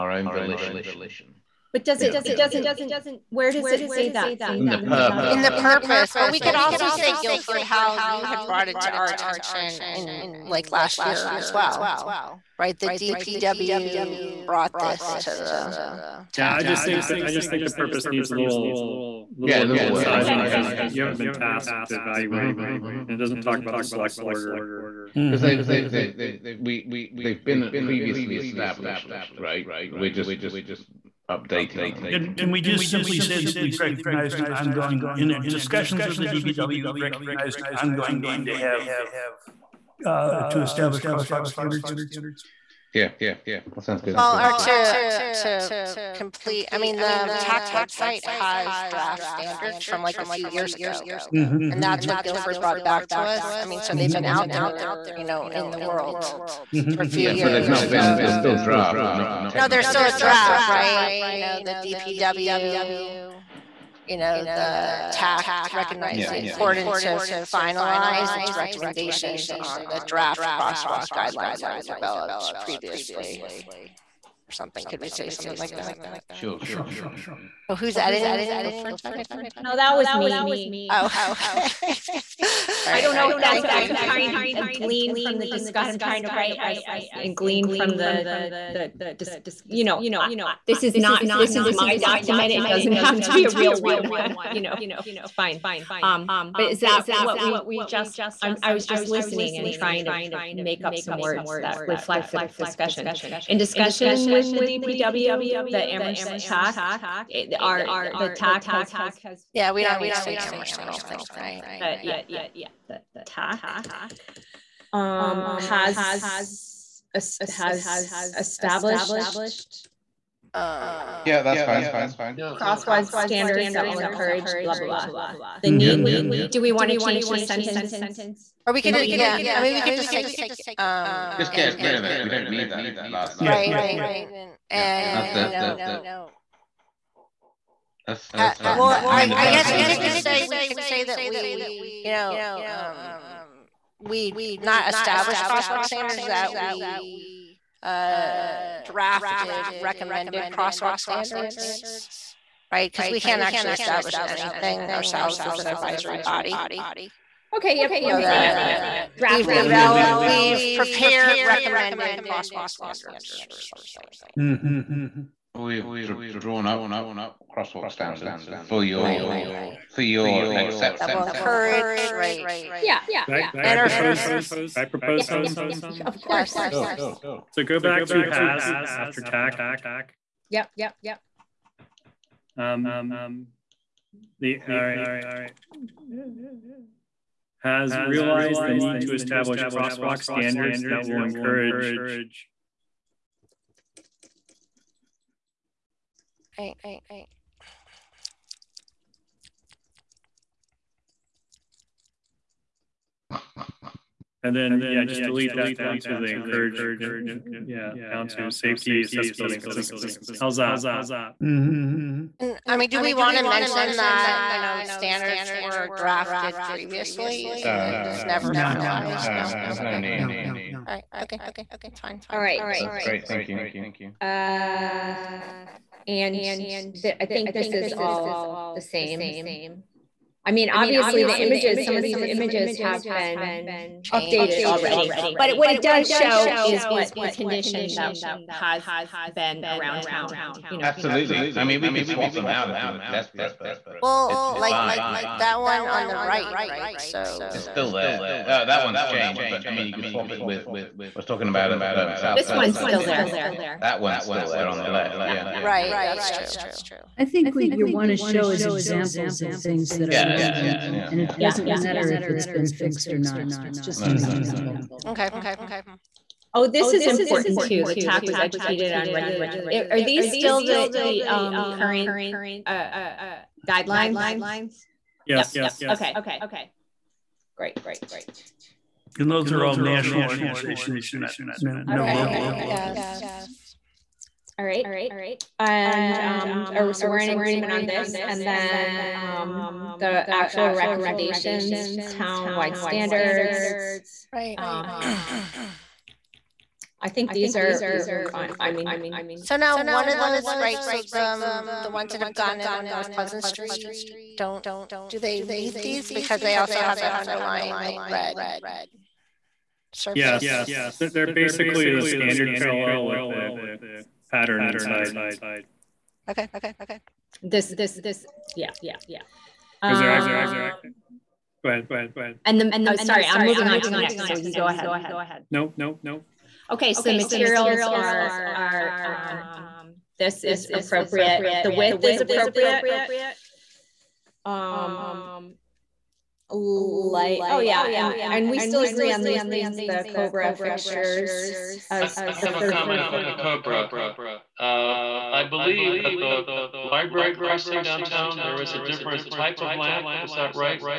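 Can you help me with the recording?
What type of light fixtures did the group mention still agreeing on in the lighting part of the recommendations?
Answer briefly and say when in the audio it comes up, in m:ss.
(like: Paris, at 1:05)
Cobra fixtures, at 5:40.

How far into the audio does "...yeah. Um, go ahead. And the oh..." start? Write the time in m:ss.
5:18.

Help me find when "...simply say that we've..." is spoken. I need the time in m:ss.
0:32.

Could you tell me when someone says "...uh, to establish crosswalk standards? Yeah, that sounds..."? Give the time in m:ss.
0:40.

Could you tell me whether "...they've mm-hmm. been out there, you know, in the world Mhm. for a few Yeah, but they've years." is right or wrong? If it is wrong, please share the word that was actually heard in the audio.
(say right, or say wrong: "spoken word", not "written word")
right.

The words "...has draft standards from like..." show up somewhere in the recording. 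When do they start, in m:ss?
0:48.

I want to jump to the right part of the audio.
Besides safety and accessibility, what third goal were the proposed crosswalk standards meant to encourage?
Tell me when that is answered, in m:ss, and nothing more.
3:29.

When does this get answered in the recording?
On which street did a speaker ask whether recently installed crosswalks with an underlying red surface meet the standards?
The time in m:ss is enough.
5:02.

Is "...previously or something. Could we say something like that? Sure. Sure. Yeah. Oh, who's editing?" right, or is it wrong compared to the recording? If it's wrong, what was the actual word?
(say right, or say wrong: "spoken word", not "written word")
right.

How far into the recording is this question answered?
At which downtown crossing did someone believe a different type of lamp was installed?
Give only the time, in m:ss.
5:46.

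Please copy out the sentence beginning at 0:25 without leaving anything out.
they, they have we they've been previously established, right?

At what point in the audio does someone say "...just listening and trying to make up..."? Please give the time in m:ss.
1:38.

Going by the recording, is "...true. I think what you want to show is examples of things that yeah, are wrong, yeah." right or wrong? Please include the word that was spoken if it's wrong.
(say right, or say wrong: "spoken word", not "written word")
right.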